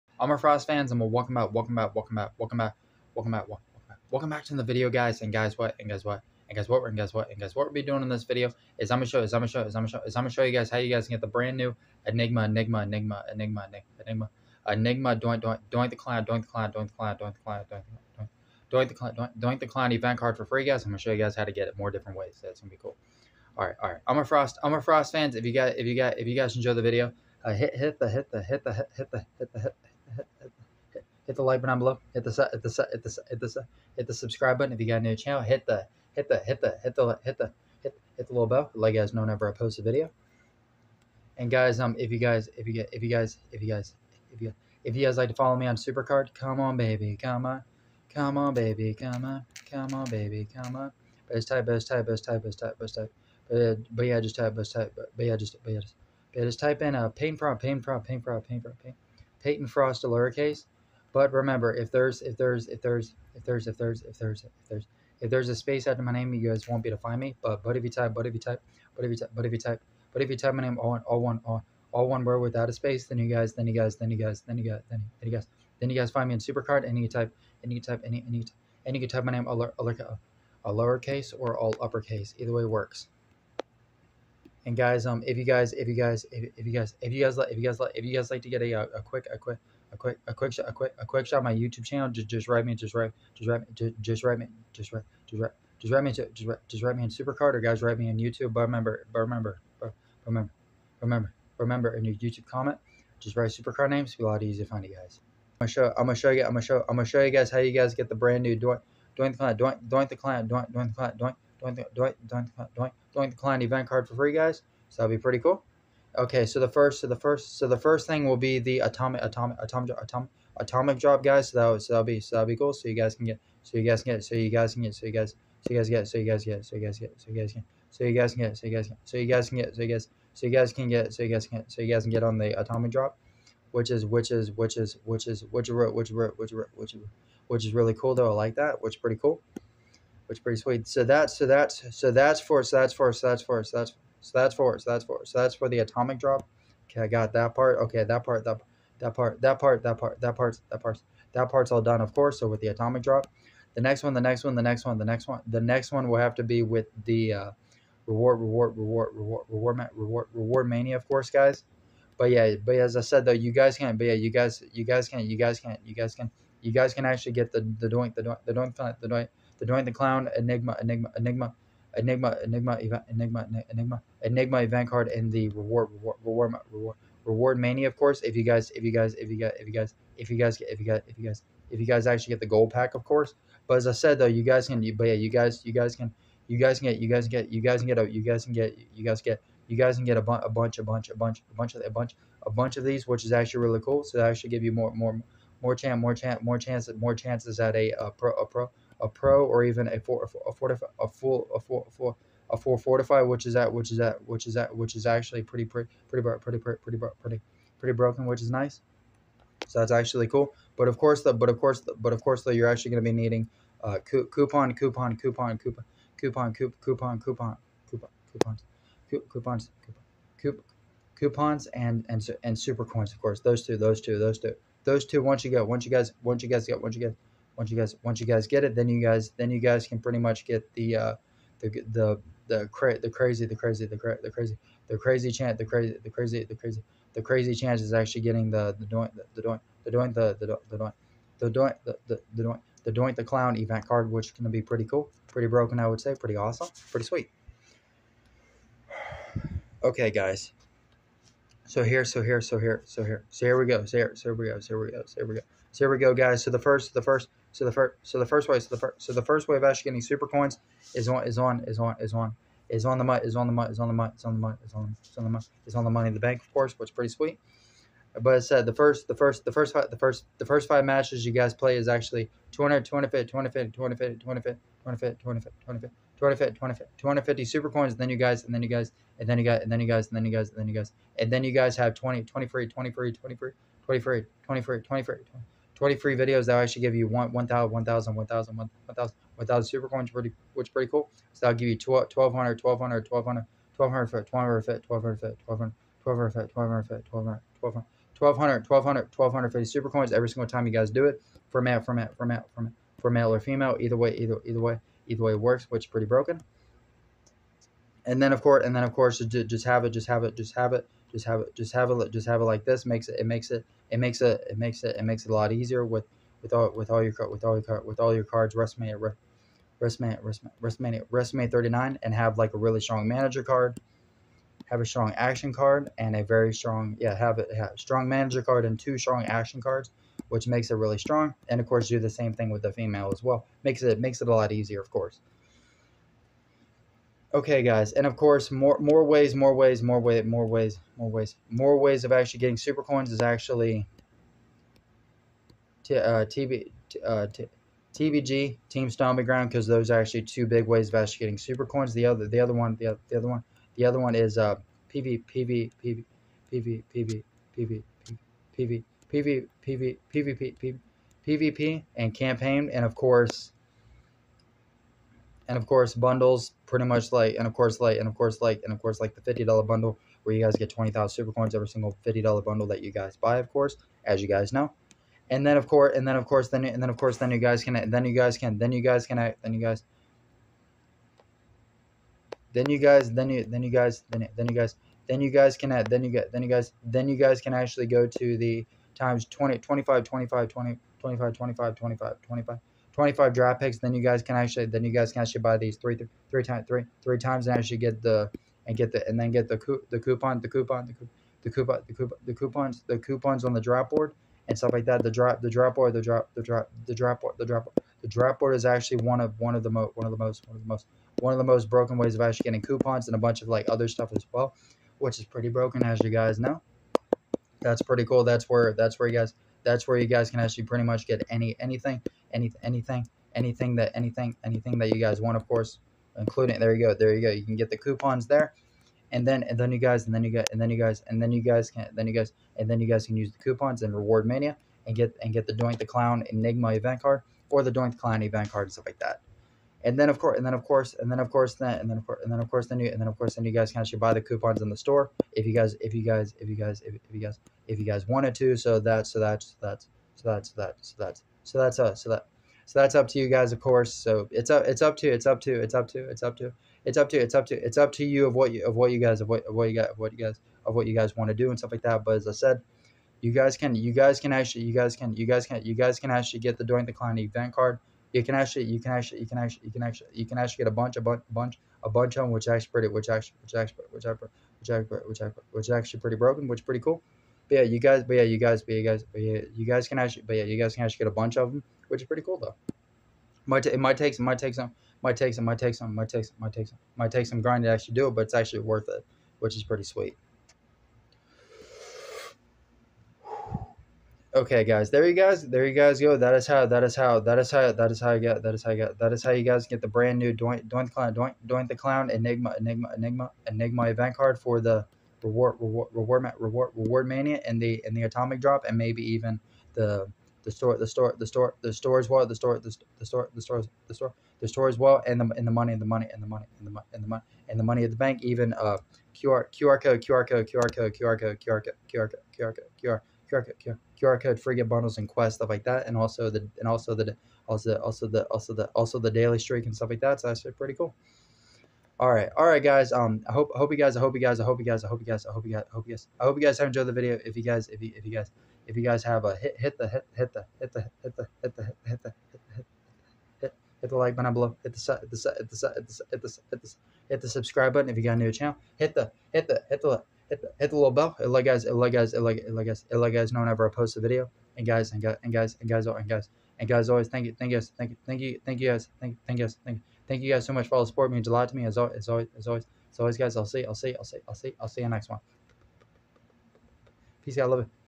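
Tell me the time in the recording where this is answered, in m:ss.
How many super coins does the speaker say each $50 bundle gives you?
6:10.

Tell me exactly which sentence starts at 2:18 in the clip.
I like that, which is pretty cool which pretty sweet.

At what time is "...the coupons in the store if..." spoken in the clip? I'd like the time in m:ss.
7:24.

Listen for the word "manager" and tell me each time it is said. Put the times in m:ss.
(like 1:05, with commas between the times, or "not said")
5:23, 5:28.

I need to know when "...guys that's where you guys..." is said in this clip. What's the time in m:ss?
6:59.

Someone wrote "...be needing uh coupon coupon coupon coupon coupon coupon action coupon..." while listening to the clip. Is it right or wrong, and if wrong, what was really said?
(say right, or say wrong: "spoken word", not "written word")
wrong: "coupon", not "action".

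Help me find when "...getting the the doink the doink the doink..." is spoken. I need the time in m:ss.
3:58.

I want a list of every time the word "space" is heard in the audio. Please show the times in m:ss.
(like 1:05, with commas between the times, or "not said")
1:05, 1:12.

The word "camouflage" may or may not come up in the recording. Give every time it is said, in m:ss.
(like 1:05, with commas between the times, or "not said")
not said.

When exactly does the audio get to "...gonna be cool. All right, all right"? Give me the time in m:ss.
0:22.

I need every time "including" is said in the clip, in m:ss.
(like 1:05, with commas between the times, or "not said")
7:06.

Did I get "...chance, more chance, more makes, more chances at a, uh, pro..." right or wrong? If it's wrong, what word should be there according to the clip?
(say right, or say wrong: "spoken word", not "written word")
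wrong: "chances", not "makes".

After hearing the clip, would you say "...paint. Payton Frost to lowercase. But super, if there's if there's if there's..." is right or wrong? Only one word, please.
wrong.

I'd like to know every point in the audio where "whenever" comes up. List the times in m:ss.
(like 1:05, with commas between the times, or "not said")
0:39, 9:13.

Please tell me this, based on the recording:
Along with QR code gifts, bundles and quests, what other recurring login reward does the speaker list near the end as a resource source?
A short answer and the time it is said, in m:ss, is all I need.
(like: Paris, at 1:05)
Daily streak, at 8:49.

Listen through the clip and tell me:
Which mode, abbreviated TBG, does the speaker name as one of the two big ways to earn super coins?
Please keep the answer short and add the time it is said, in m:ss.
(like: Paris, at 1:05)
Team Stomping Ground, at 5:48.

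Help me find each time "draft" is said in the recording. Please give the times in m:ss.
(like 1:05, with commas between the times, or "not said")
6:33, 6:43.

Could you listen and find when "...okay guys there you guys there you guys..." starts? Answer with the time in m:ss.
8:14.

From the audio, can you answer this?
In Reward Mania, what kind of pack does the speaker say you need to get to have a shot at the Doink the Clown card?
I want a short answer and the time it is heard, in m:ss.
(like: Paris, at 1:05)
Gold pack, at 3:02.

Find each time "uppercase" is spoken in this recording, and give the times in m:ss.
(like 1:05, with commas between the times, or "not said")
1:21.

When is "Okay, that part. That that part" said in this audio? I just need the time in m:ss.
2:27.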